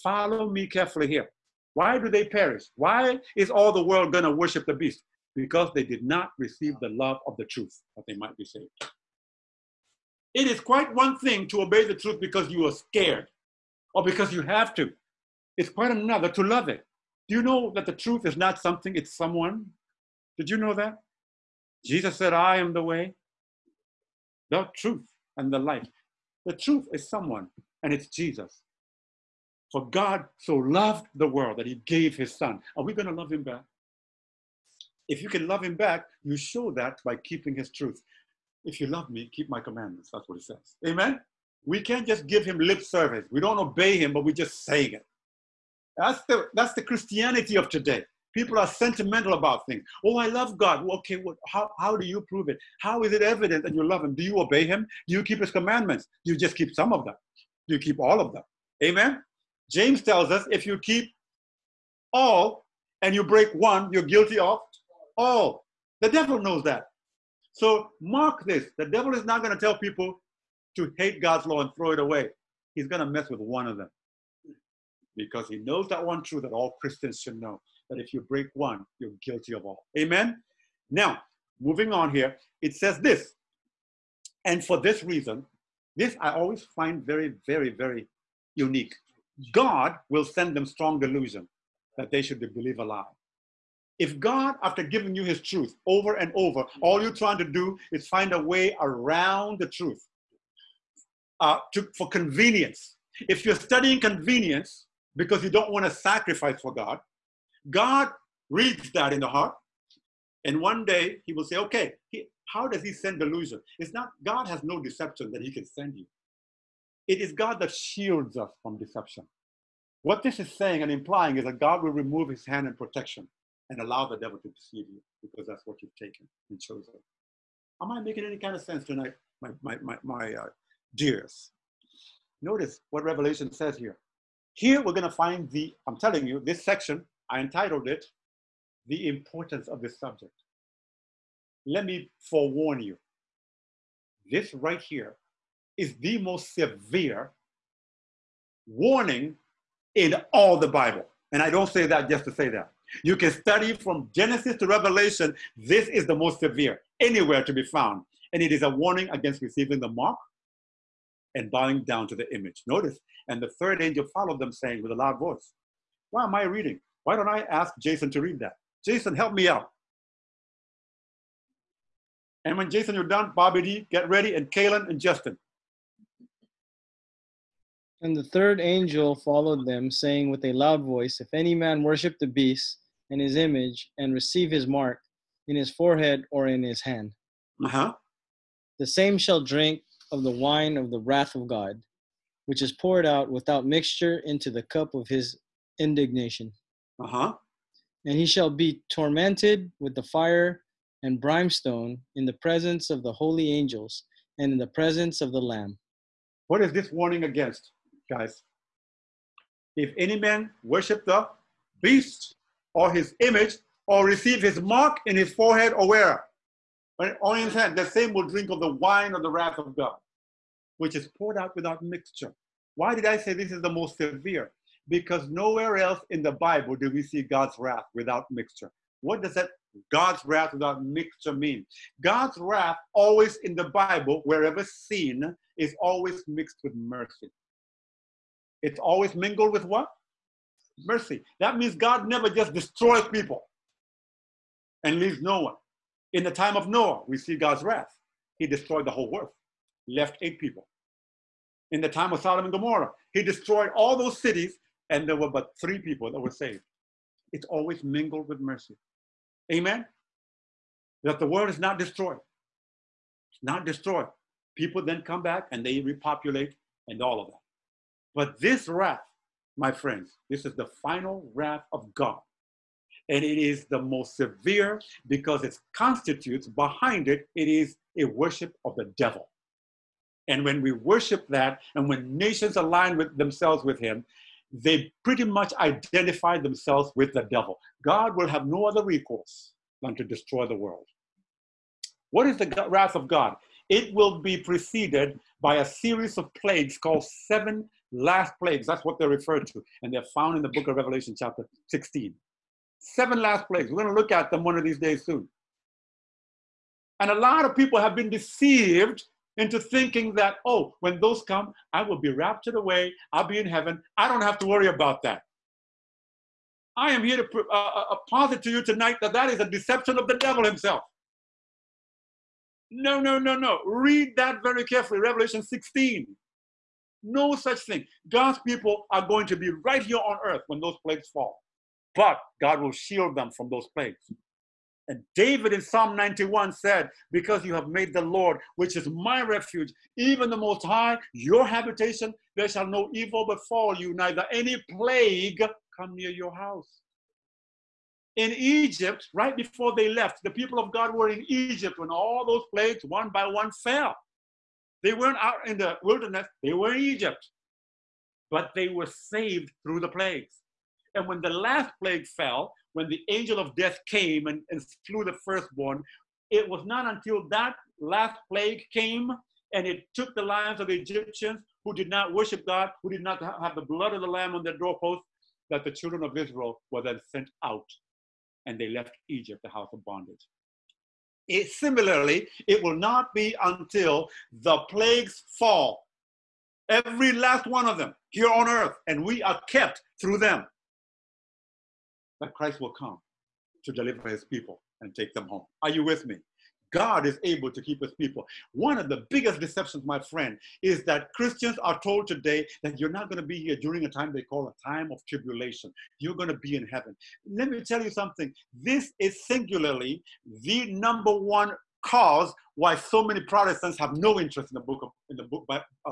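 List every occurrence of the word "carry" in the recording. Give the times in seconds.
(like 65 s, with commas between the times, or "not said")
not said.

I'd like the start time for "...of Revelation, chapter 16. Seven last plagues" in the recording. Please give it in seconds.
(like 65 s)
300 s.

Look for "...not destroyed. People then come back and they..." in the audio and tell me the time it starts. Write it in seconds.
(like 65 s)
263 s.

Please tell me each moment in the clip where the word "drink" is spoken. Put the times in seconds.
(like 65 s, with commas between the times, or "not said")
189 s, 218 s.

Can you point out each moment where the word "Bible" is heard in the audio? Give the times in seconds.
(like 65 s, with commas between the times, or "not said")
150 s, 226 s, 233 s.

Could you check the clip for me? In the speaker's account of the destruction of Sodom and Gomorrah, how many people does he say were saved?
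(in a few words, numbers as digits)
3.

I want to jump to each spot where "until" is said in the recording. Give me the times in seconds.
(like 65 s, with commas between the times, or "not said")
366 s, 383 s.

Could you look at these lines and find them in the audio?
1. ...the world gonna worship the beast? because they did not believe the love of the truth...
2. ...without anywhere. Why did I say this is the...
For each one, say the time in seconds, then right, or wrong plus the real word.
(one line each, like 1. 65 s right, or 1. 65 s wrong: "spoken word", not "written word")
1. 3 s wrong: "receive", not "believe"
2. 221 s wrong: "mixture", not "anywhere".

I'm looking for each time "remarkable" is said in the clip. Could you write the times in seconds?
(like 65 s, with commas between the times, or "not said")
not said.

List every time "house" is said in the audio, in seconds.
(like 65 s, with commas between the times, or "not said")
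346 s, 379 s.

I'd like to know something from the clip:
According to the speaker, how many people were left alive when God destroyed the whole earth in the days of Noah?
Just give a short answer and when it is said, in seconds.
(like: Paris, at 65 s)
8, at 250 s.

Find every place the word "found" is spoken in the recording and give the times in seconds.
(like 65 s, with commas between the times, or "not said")
157 s, 300 s.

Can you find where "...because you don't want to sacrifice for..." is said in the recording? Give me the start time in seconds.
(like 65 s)
105 s.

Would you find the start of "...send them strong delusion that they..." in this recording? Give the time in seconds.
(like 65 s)
90 s.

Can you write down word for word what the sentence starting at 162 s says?
Notice, and the third angel followed them, saying with a loud voice, Why am I reading?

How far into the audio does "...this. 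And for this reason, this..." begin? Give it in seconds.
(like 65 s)
82 s.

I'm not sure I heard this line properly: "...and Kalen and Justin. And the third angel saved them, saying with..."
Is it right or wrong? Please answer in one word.
wrong.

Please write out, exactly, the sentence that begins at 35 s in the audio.
If you can love him back, you show that by keeping his truth.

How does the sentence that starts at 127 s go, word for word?
Am I making any kind of sense tonight, my, my, my, my uh, dears?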